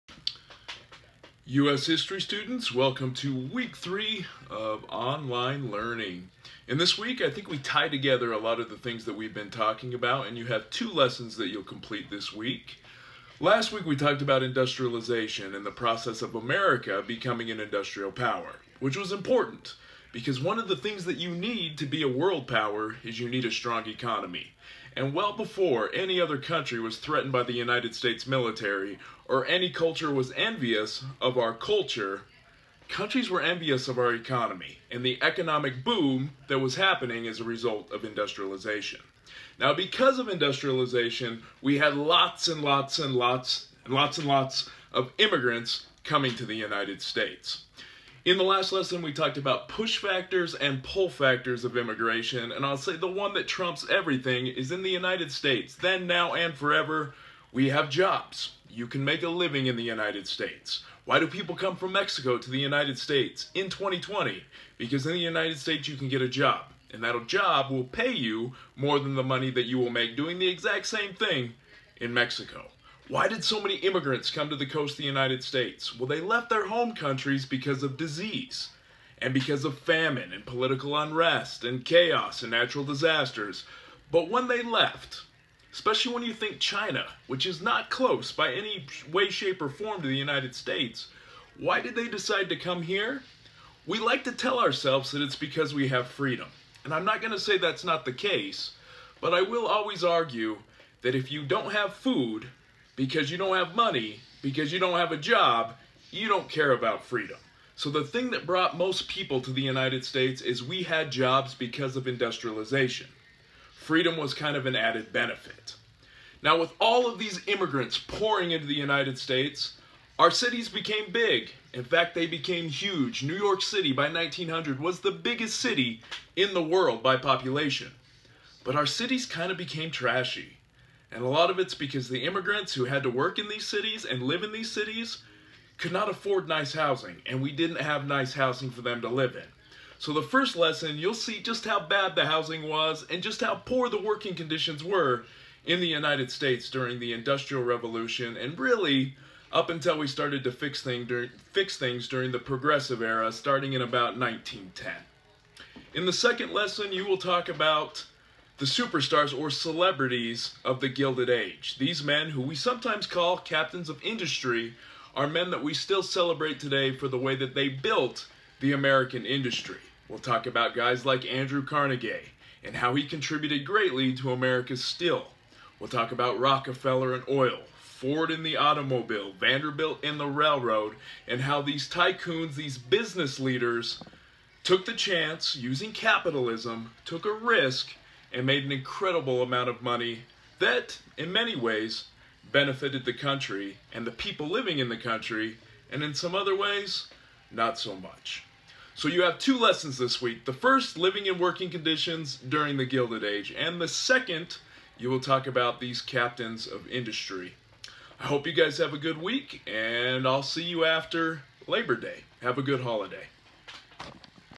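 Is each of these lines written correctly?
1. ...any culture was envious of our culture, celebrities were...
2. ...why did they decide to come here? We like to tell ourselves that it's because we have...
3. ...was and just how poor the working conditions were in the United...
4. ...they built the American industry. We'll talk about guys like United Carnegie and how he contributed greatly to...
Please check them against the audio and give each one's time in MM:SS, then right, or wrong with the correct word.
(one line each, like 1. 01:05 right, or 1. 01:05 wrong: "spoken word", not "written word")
1. 00:29 wrong: "countries", not "celebrities"
2. 01:31 right
3. 02:22 right
4. 02:47 wrong: "Andrew", not "United".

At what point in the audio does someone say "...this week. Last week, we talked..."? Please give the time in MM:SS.
00:12.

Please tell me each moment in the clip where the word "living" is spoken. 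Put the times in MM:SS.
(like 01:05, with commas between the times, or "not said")
00:59, 03:14, 03:20.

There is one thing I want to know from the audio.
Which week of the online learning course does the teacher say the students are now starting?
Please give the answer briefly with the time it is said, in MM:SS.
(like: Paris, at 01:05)
week 3, at 00:03.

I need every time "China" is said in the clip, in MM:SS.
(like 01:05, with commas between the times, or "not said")
01:26.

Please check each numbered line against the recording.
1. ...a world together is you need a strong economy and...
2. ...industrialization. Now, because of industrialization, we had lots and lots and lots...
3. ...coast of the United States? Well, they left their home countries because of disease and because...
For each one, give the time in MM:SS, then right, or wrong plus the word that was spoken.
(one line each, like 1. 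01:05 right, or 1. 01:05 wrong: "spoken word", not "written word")
1. 00:22 wrong: "power", not "together"
2. 00:38 right
3. 01:14 right.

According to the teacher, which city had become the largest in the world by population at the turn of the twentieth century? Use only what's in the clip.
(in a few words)
New York City.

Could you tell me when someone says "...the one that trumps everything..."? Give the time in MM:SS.
00:52.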